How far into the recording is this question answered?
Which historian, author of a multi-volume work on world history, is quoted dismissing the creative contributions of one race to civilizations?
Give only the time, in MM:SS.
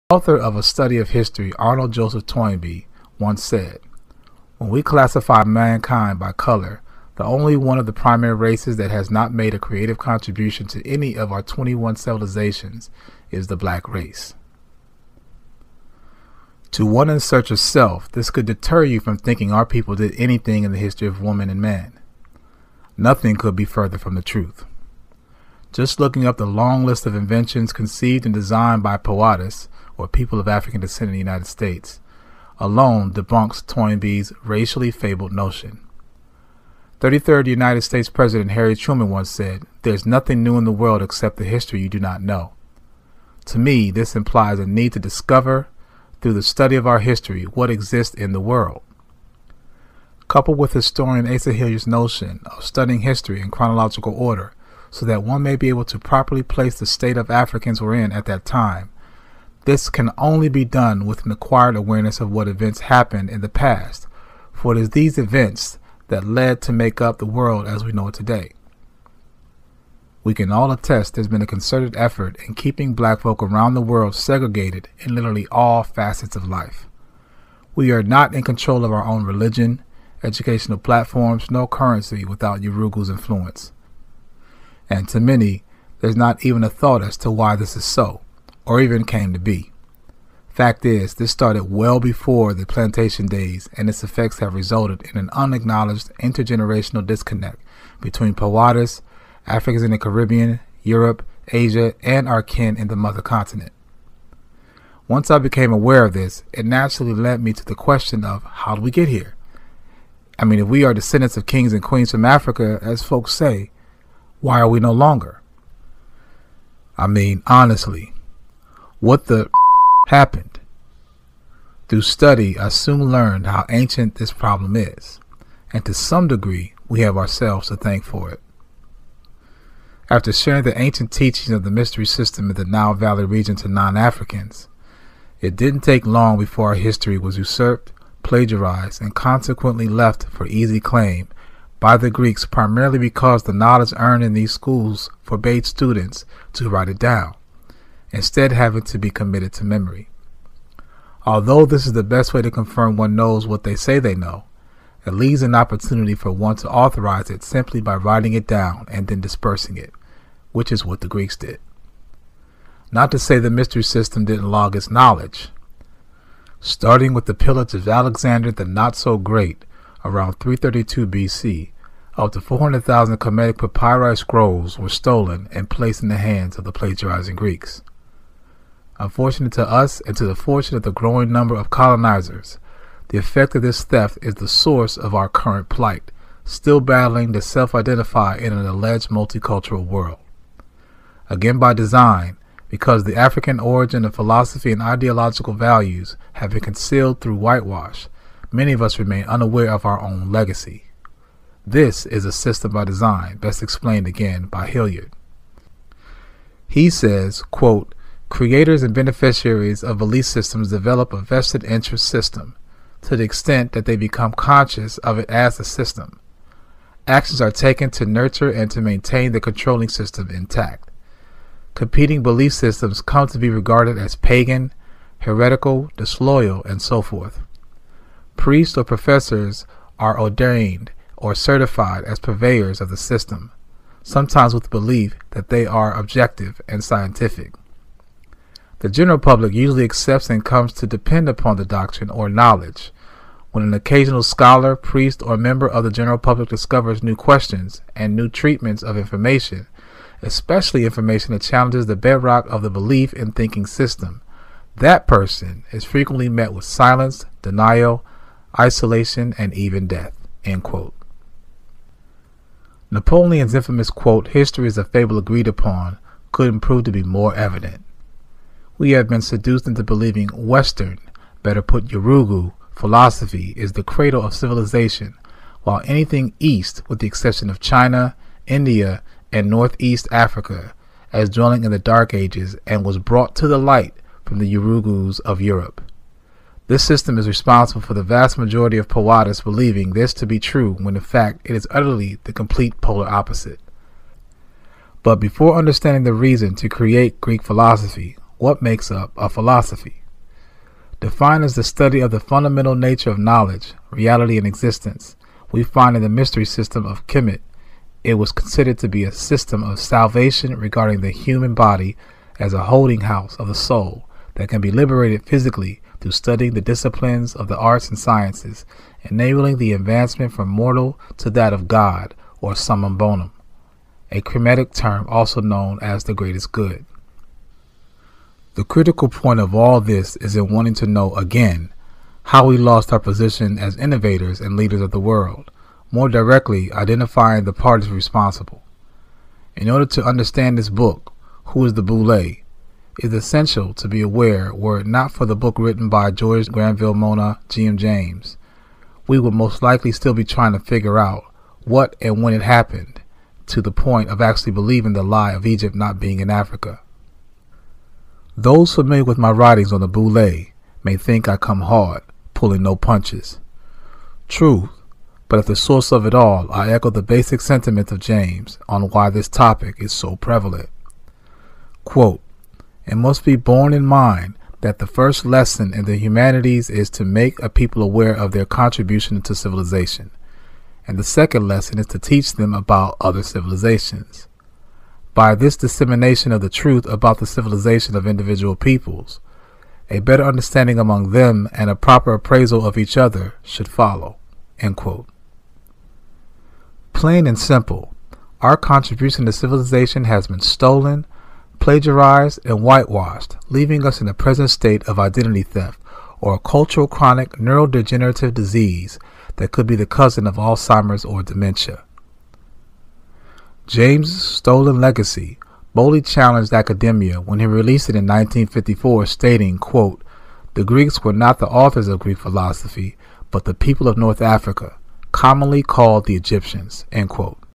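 00:01.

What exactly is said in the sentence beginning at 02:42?
Not to say the mystery system didn't log its knowledge.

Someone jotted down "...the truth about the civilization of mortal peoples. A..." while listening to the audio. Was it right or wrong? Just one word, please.
wrong.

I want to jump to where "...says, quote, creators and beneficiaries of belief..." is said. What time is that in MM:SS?
03:26.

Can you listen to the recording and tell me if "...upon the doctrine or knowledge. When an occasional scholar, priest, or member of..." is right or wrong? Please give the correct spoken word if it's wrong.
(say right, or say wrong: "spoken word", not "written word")
right.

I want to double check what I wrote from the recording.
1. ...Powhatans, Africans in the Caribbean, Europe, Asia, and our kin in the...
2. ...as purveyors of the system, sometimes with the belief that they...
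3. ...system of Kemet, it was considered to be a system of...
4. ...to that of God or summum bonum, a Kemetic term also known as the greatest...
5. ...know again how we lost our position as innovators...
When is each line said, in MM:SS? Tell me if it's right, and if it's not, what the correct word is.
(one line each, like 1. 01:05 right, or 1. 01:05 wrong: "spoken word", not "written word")
1. 01:38 right
2. 03:52 right
3. 05:06 right
4. 05:21 right
5. 05:30 right.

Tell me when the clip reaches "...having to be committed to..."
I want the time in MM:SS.
02:28.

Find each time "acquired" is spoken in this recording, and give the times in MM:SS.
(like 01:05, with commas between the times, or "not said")
01:01.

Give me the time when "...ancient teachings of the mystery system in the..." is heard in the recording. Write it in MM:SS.
02:10.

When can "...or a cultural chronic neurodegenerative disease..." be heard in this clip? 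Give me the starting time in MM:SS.
06:46.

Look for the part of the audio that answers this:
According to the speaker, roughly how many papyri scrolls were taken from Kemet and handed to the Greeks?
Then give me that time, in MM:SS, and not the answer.
02:52.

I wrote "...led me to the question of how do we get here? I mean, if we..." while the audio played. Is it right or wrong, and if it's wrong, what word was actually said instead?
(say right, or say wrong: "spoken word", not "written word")
right.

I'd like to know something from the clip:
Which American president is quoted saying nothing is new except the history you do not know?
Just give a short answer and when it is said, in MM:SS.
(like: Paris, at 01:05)
Harry Truman, at 00:38.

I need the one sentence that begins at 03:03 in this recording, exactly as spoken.
The effect of this theft is the source of our current plight, still battling to self identify in an alleged multicultural world.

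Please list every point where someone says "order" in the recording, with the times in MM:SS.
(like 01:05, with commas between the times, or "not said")
00:54, 05:39.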